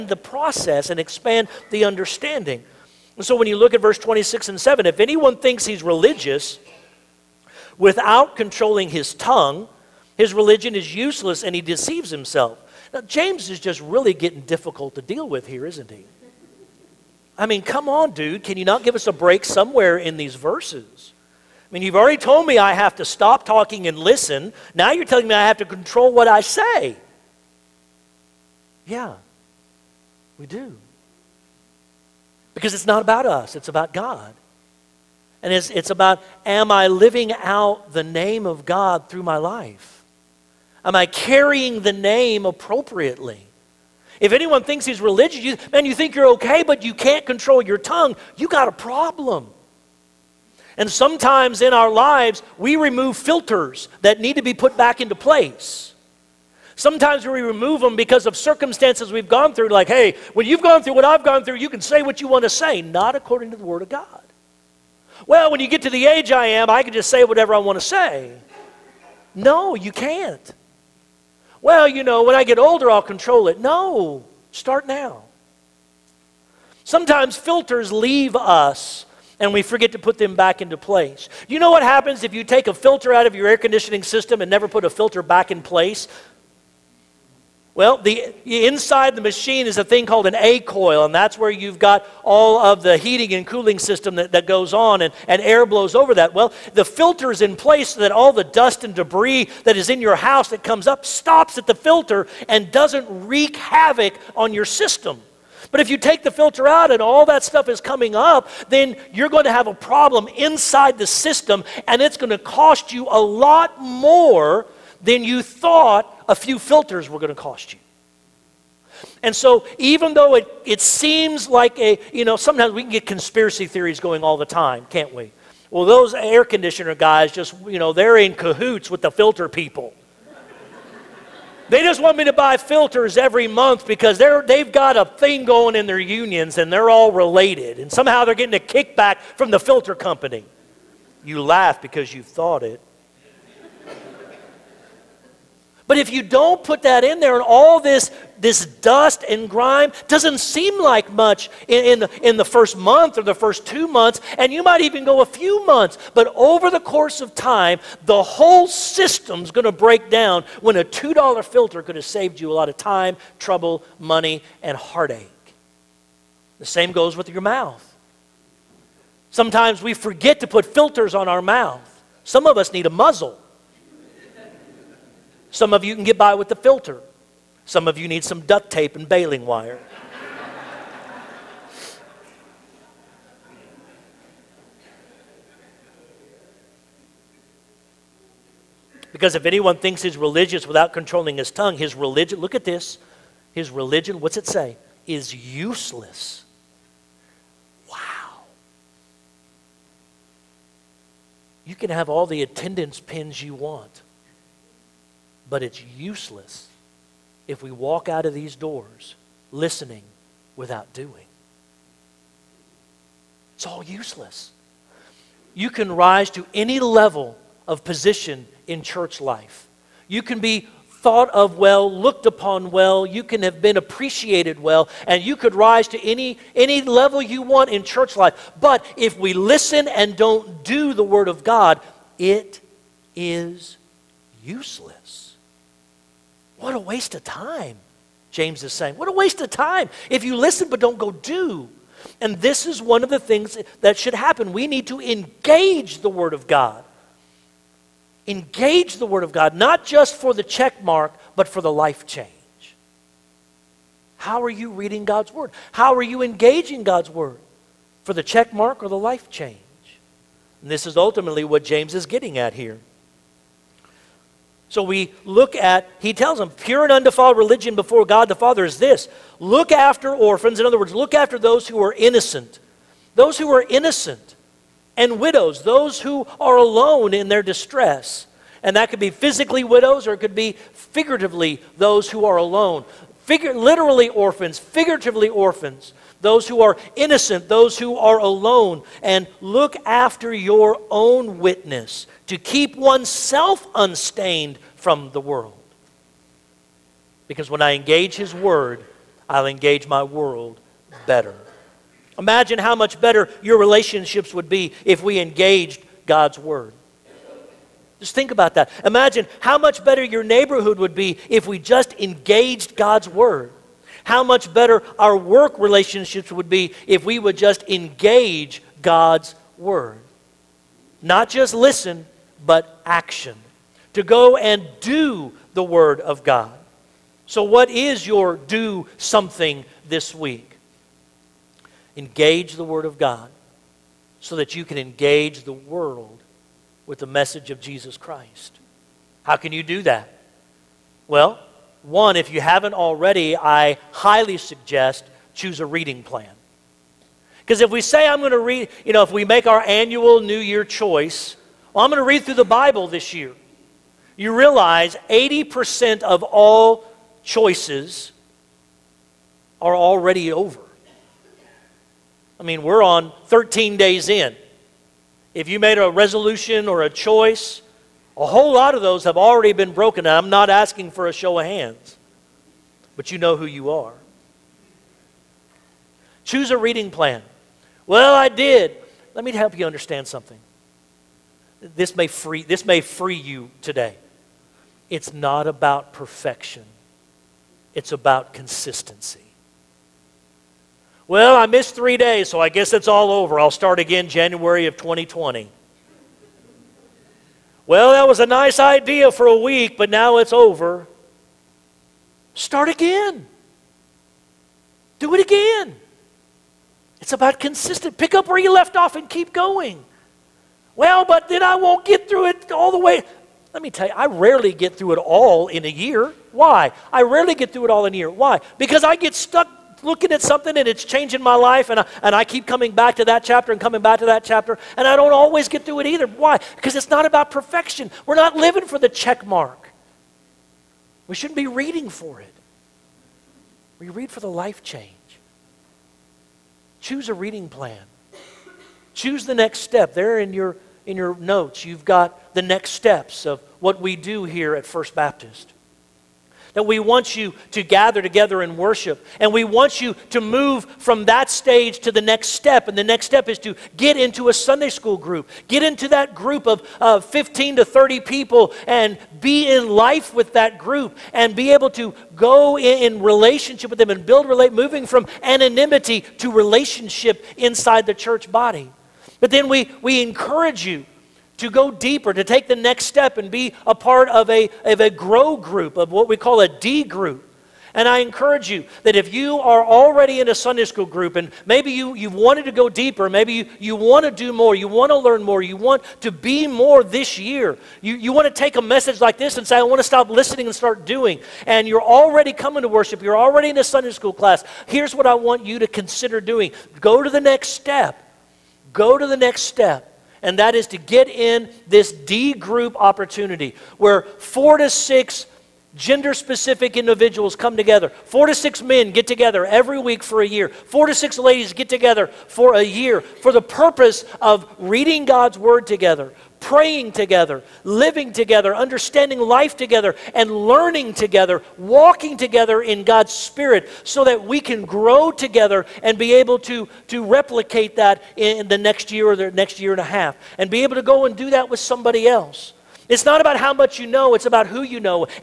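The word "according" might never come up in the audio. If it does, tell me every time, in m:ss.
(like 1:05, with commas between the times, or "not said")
1:03.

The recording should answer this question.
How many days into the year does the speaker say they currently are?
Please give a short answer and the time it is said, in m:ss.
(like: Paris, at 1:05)
13, at 6:03.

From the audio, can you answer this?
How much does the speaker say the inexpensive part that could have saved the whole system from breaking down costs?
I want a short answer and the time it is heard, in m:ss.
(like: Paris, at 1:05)
$2, at 2:40.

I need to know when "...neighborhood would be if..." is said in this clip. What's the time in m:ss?
5:10.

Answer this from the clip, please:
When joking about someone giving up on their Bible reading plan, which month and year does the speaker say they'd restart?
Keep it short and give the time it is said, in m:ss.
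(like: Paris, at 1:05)
January 2020, at 6:34.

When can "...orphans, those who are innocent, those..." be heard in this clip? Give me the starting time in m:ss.
4:45.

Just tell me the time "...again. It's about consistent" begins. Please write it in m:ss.
6:45.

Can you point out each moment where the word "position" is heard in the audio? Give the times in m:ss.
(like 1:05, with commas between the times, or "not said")
3:37.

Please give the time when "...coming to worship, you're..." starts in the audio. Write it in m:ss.
8:12.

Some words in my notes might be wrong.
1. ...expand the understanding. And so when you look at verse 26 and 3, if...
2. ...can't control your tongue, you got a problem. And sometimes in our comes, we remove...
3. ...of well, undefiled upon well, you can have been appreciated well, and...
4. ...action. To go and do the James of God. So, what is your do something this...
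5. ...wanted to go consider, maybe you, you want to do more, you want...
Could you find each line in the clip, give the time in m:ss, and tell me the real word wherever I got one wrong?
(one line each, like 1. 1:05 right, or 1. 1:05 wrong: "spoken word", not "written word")
1. 0:00 wrong: "7", not "3"
2. 0:46 wrong: "lives", not "comes"
3. 3:41 wrong: "looked", not "undefiled"
4. 5:22 wrong: "Word", not "James"
5. 8:02 wrong: "deeper", not "consider".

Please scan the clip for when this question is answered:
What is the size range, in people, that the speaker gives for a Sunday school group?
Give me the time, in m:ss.
7:37.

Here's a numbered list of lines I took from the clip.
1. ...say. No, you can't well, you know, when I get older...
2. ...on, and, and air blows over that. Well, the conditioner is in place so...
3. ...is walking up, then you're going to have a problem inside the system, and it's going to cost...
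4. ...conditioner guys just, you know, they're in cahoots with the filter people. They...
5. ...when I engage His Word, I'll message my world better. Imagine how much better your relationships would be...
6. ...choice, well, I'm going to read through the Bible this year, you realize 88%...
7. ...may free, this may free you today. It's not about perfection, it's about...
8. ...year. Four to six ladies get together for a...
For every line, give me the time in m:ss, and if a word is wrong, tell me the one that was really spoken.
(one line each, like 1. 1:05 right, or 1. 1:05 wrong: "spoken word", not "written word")
1. 1:07 right
2. 1:34 wrong: "filter", not "conditioner"
3. 1:47 wrong: "coming", not "walking"
4. 2:06 right
5. 4:57 wrong: "engage", not "message"
6. 5:50 wrong: "80", not "88"
7. 6:21 right
8. 8:30 right.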